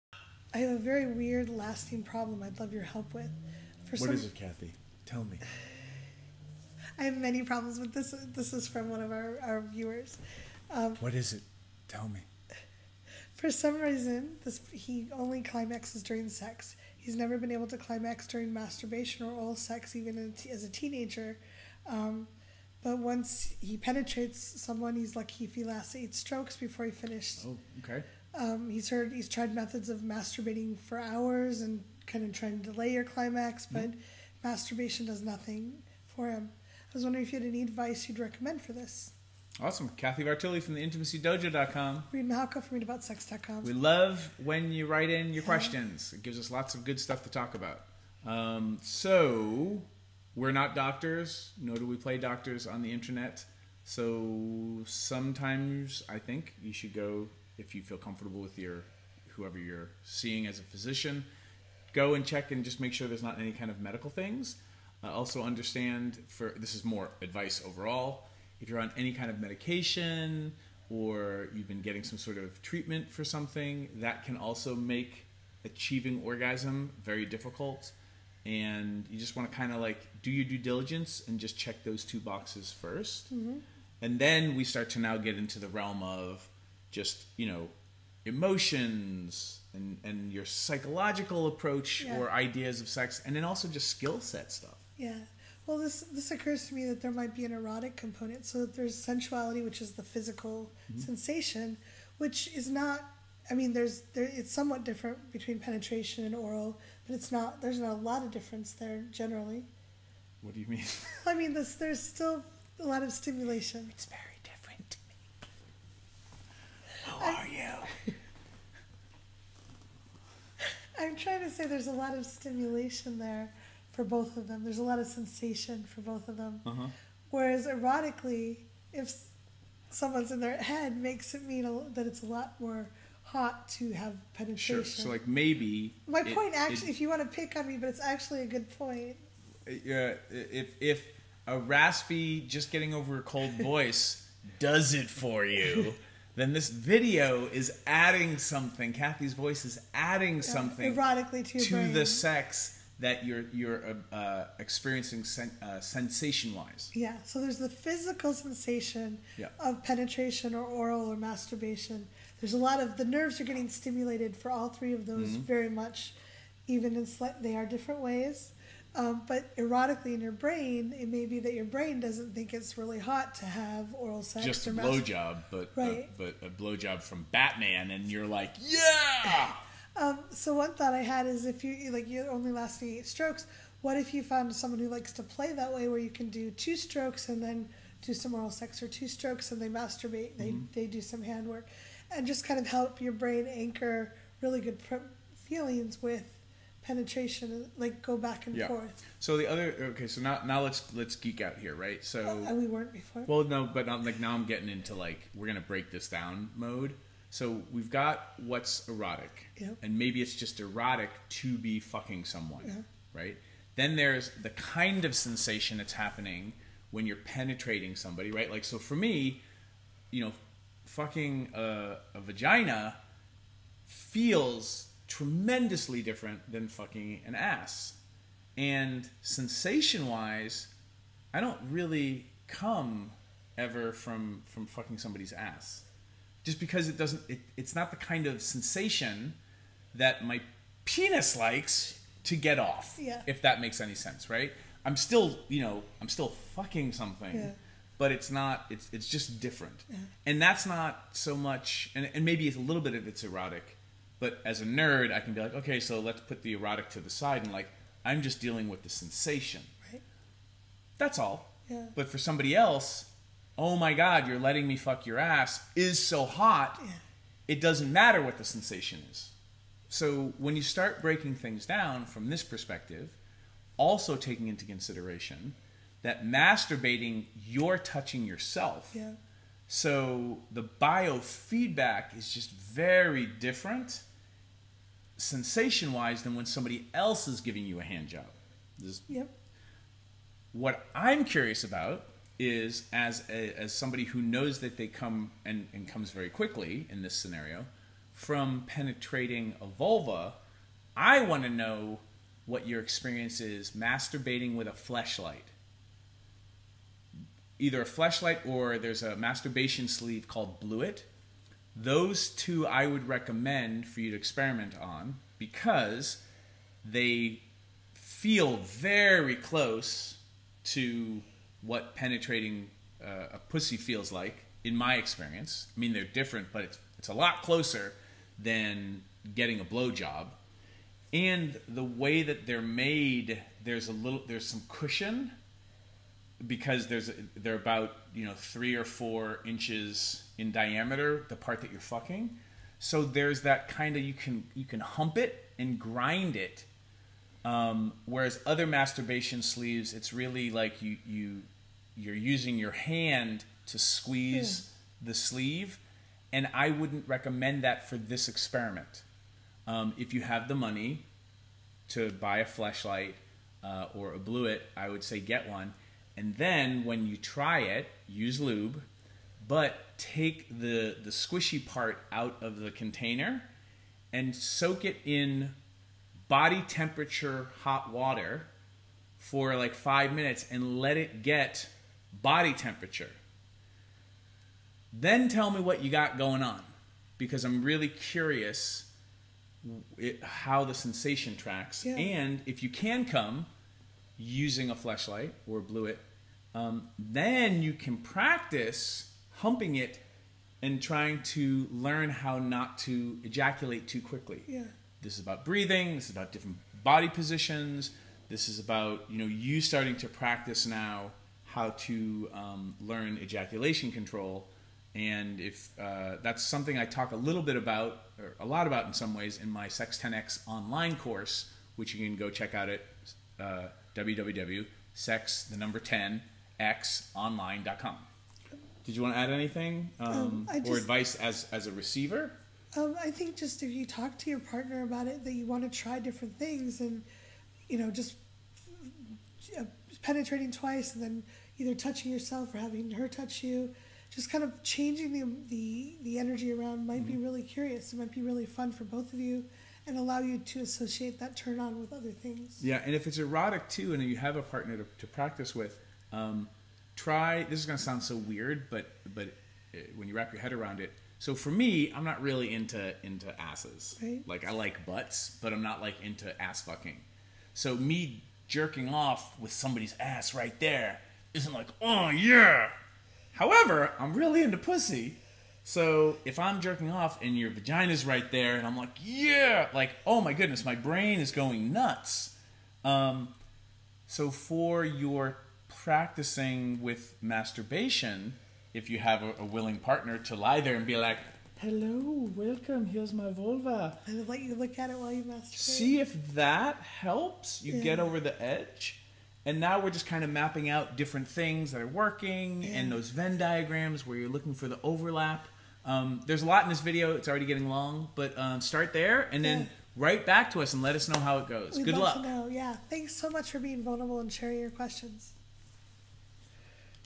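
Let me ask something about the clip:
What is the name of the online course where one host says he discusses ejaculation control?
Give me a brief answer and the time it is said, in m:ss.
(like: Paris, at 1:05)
Sex 10X, at 6:59.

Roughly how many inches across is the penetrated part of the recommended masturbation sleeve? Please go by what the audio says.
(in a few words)
3 or 4 inches.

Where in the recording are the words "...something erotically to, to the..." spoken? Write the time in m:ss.
2:30.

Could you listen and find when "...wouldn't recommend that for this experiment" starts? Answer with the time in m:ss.
5:56.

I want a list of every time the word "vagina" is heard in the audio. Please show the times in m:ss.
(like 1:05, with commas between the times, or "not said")
3:42, 7:57.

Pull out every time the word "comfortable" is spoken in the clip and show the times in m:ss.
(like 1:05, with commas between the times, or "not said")
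0:57.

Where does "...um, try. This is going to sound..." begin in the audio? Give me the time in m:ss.
7:36.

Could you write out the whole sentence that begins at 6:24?
Then tell me what you got going on because I'm really curious it, how the sensation tracks.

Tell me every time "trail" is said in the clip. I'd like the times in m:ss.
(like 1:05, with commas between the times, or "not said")
not said.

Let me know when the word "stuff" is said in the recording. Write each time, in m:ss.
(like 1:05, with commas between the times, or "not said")
0:46, 1:34.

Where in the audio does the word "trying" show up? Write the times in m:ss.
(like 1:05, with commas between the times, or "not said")
0:32, 2:01, 6:40.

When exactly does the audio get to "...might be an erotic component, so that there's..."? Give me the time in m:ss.
1:37.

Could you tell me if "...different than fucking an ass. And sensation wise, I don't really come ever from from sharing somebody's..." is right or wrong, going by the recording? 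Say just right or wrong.
wrong.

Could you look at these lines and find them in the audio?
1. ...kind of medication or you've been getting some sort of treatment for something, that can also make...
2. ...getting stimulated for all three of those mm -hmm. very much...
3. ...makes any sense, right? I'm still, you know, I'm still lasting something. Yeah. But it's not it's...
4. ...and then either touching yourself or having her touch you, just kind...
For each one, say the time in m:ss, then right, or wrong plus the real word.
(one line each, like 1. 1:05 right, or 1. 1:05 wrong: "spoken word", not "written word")
1. 1:09 right
2. 2:43 right
3. 4:03 wrong: "fucking", not "lasting"
4. 7:20 right.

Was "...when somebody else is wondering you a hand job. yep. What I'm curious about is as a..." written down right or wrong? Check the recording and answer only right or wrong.
wrong.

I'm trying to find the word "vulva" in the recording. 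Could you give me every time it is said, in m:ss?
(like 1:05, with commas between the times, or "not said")
4:59, 8:13.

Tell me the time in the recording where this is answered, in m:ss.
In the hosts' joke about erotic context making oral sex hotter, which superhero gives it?
2:57.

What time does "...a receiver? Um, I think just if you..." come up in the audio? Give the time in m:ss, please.
7:11.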